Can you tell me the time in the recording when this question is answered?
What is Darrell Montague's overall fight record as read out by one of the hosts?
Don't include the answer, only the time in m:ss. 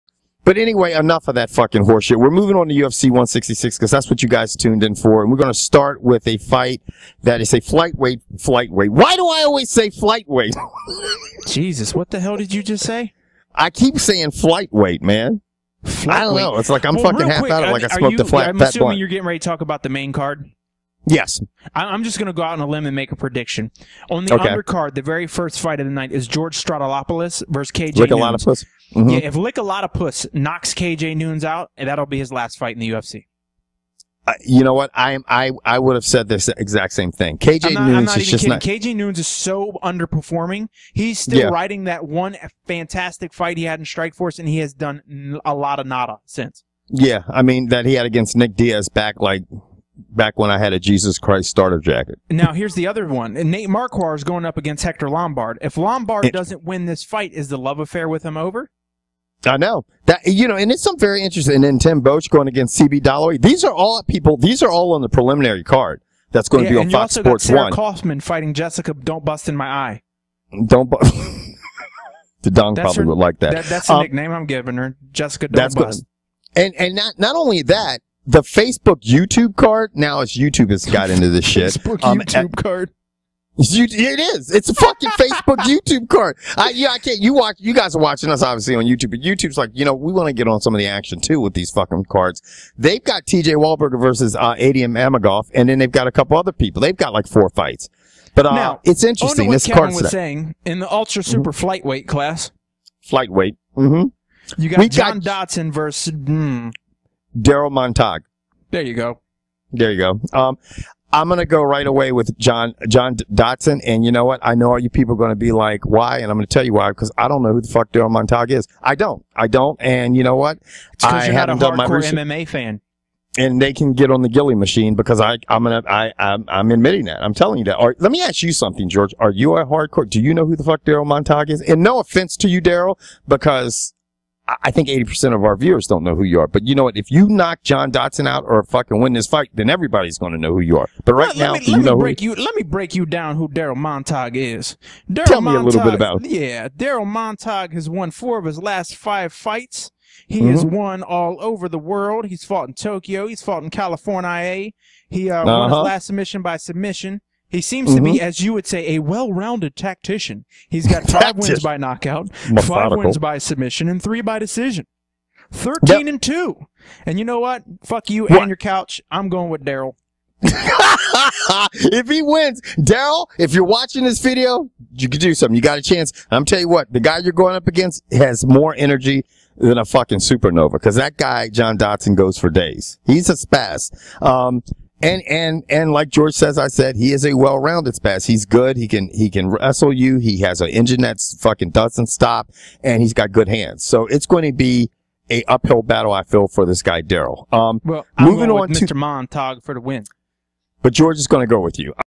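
2:45.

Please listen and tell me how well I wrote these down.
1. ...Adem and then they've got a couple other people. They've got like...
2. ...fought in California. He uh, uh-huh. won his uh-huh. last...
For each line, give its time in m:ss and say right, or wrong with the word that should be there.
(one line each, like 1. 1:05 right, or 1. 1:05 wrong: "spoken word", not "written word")
1. 1:34 right
2. 2:33 right.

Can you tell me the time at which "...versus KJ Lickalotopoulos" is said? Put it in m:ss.
0:27.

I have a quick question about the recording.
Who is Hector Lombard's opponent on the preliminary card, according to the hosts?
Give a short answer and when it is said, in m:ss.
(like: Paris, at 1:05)
Nate Marquardt, at 0:53.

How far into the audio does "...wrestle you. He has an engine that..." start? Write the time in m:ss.
3:09.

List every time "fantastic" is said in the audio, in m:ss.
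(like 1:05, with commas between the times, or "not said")
0:42.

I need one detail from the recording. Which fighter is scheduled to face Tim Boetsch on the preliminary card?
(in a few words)
CB Dollaway.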